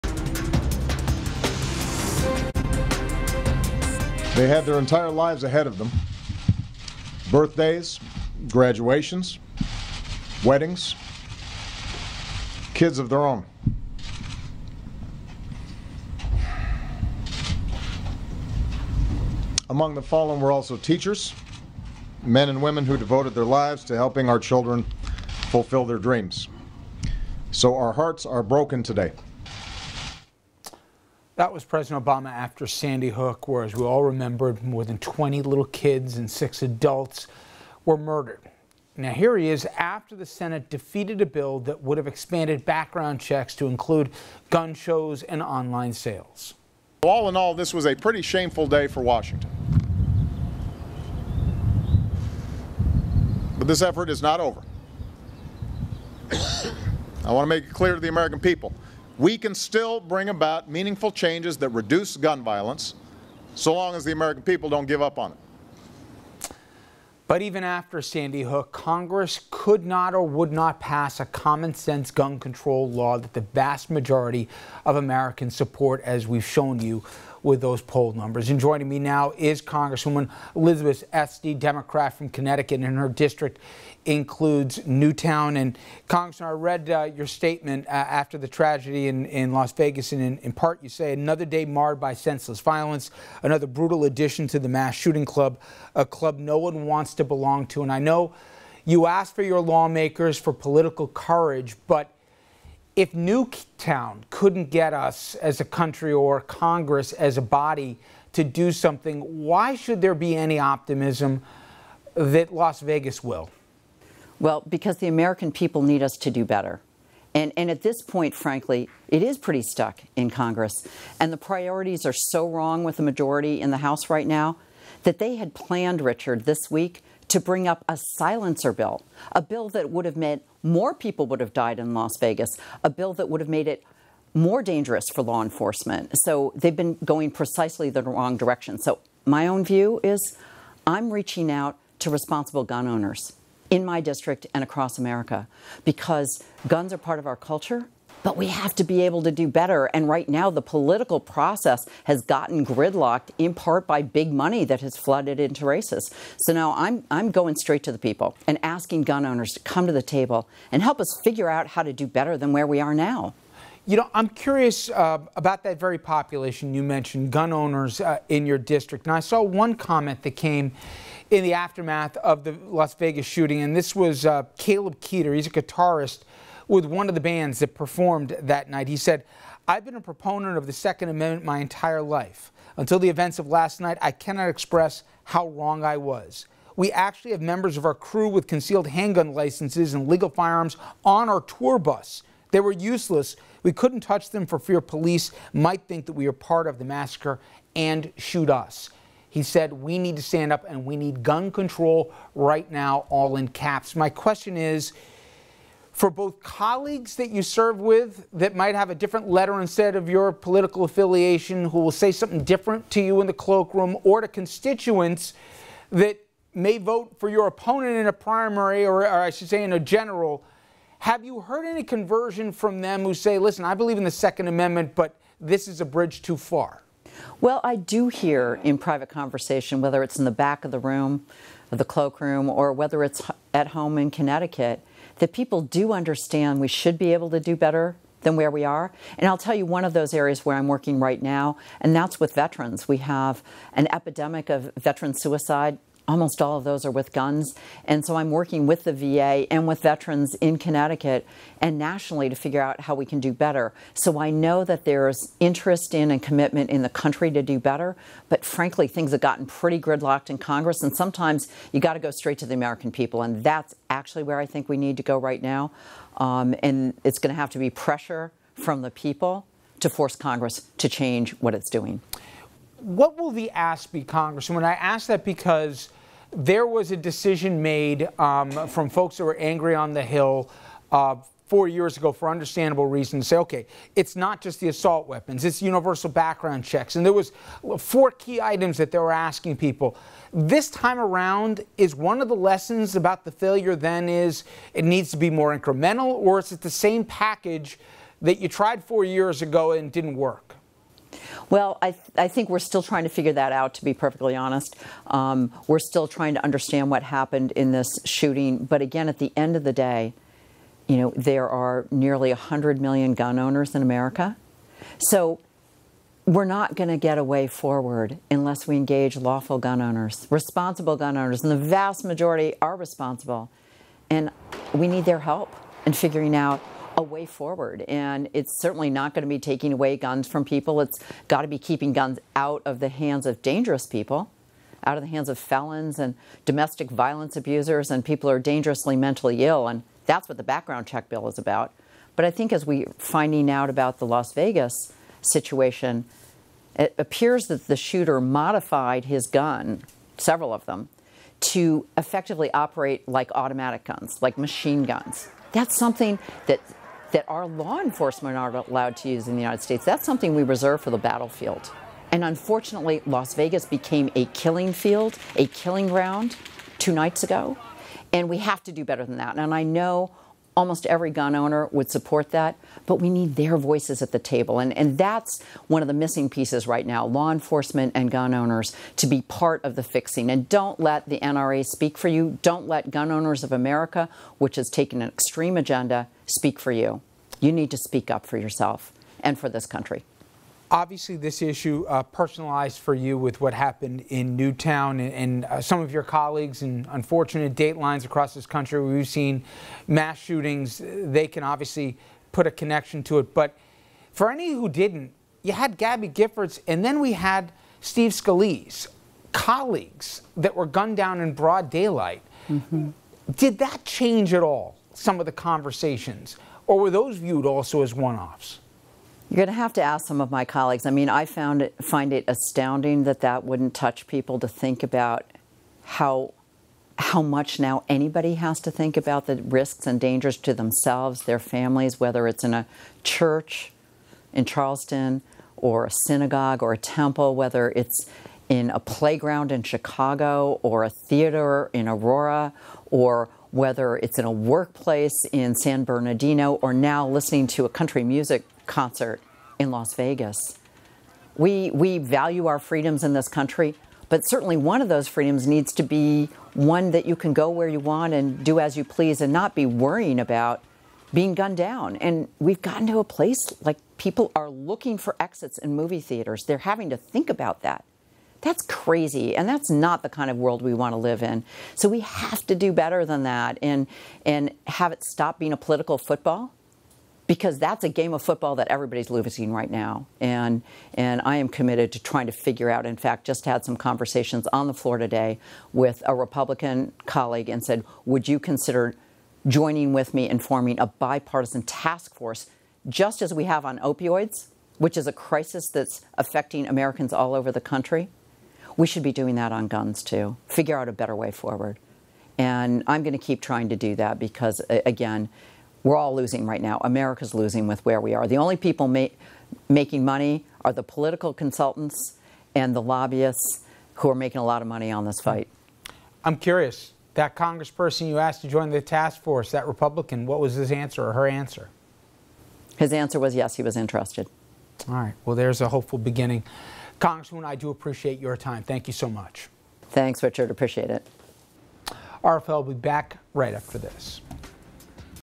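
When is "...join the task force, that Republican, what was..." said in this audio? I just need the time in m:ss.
8:38.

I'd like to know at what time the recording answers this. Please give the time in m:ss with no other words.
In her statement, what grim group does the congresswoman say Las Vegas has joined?
1:34.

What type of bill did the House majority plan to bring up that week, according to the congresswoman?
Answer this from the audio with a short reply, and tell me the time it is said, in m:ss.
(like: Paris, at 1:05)
silencer bill, at 2:07.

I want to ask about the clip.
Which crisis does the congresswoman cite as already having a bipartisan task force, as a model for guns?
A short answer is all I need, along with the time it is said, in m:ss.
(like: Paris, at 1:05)
opioids, at 8:13.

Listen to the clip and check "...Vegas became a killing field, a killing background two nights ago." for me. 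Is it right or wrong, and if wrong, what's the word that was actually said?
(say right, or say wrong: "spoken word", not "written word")
wrong: "ground", not "background".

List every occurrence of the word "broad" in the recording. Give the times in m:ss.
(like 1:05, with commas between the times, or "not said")
6:51.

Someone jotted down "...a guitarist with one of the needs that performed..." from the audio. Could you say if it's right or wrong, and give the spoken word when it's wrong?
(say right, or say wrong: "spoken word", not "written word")
wrong: "bands", not "needs".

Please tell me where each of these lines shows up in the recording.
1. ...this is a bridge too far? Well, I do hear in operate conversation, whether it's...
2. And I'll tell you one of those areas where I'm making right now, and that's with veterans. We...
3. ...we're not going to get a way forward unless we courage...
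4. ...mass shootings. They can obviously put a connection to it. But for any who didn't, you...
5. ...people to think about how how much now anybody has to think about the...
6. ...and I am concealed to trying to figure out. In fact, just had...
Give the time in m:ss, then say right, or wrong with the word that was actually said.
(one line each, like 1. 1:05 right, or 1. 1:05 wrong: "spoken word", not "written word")
1. 3:45 wrong: "private", not "operate"
2. 3:59 wrong: "working", not "making"
3. 5:16 wrong: "engage", not "courage"
4. 6:39 right
5. 7:04 right
6. 8:00 wrong: "committed", not "concealed".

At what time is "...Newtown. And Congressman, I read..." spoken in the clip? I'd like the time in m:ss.
1:24.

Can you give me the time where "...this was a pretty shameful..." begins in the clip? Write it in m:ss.
0:47.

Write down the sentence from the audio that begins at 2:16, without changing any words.
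So they've been going precisely the wrong direction.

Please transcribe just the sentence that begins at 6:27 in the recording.
You need to speak up for yourself and for this country.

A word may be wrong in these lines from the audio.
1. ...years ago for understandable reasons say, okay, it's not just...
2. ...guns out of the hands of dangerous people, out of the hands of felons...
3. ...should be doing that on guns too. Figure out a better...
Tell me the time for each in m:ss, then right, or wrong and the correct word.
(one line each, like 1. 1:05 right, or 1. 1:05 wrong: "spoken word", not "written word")
1. 4:41 right
2. 5:31 right
3. 8:18 right.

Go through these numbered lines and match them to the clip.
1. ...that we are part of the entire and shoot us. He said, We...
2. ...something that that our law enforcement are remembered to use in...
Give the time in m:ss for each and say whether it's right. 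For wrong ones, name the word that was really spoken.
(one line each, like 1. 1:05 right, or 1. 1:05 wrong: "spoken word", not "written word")
1. 3:16 wrong: "massacre", not "entire"
2. 5:55 wrong: "allowed", not "remembered".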